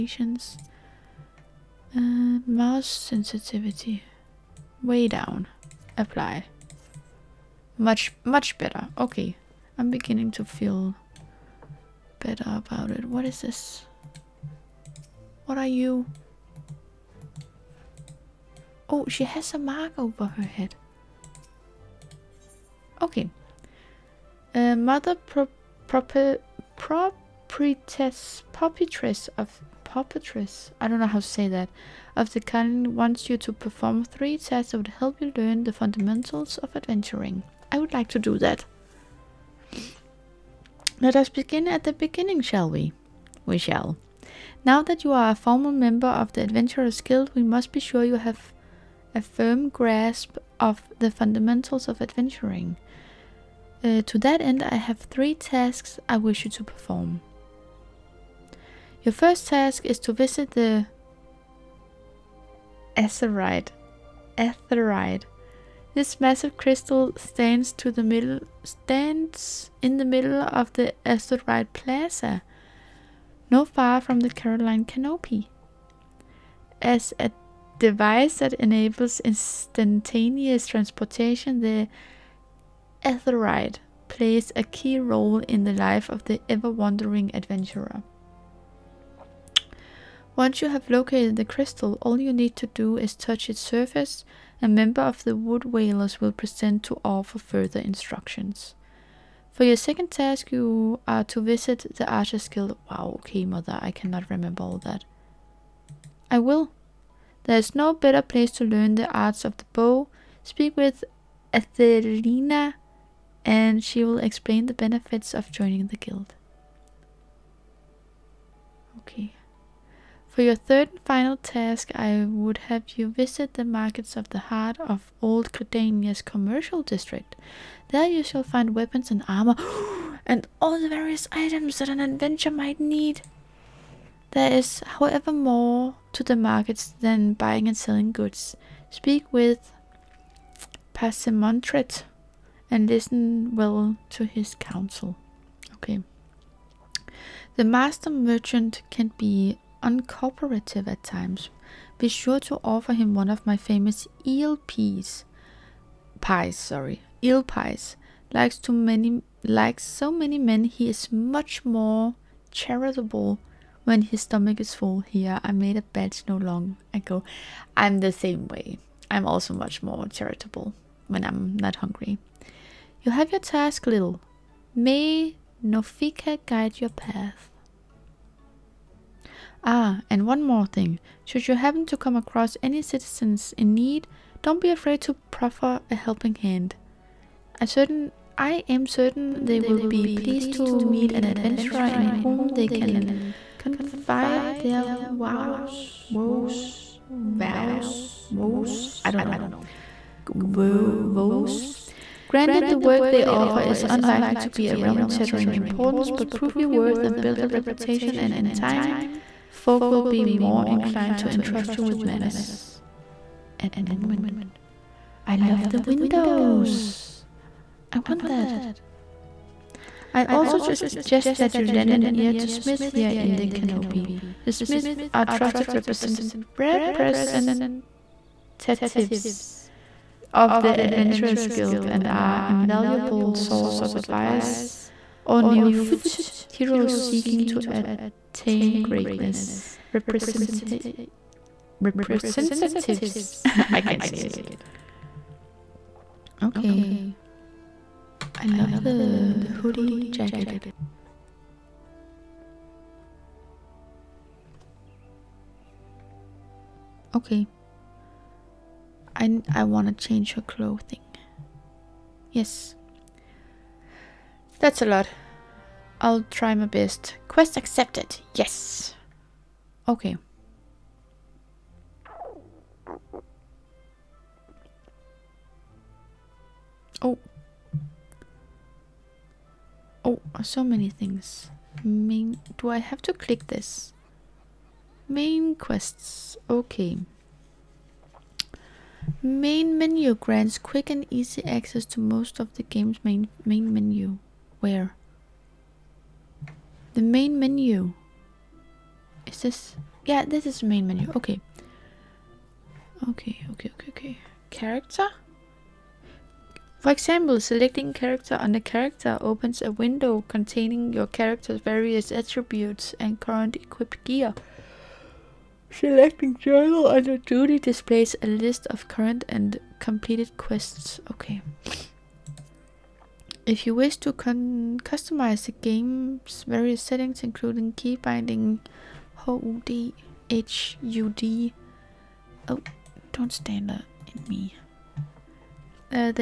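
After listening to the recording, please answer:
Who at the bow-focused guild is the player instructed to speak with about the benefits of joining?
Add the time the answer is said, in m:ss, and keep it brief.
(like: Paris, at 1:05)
Athelina, at 1:51.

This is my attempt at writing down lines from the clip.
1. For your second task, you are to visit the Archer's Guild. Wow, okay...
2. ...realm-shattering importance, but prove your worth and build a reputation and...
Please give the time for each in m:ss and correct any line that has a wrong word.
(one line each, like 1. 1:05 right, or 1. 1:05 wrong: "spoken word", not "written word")
1. 1:39 right
2. 3:24 right.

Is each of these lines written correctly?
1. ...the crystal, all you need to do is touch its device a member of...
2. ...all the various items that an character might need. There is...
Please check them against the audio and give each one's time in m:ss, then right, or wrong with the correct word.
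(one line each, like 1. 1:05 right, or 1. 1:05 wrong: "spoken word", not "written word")
1. 1:31 wrong: "surface", not "device"
2. 2:10 wrong: "adventurer", not "character".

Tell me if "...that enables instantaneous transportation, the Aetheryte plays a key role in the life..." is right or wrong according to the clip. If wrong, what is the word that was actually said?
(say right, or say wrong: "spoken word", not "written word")
right.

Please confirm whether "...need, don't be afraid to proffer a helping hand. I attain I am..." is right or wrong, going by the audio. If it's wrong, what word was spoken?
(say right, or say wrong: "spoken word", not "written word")
wrong: "certain", not "attain".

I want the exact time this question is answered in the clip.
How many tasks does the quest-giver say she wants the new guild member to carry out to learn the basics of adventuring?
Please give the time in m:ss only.
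0:34.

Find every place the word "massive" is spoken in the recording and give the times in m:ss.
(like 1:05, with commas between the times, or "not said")
1:06.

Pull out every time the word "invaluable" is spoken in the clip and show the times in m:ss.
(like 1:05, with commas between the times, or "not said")
3:52.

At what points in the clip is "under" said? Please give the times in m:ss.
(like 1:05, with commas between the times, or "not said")
5:08, 5:16.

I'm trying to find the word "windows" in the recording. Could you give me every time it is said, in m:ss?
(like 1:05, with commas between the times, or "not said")
3:35, 5:09.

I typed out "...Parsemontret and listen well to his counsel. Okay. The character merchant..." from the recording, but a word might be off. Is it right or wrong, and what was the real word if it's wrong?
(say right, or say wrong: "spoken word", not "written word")
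wrong: "master", not "character".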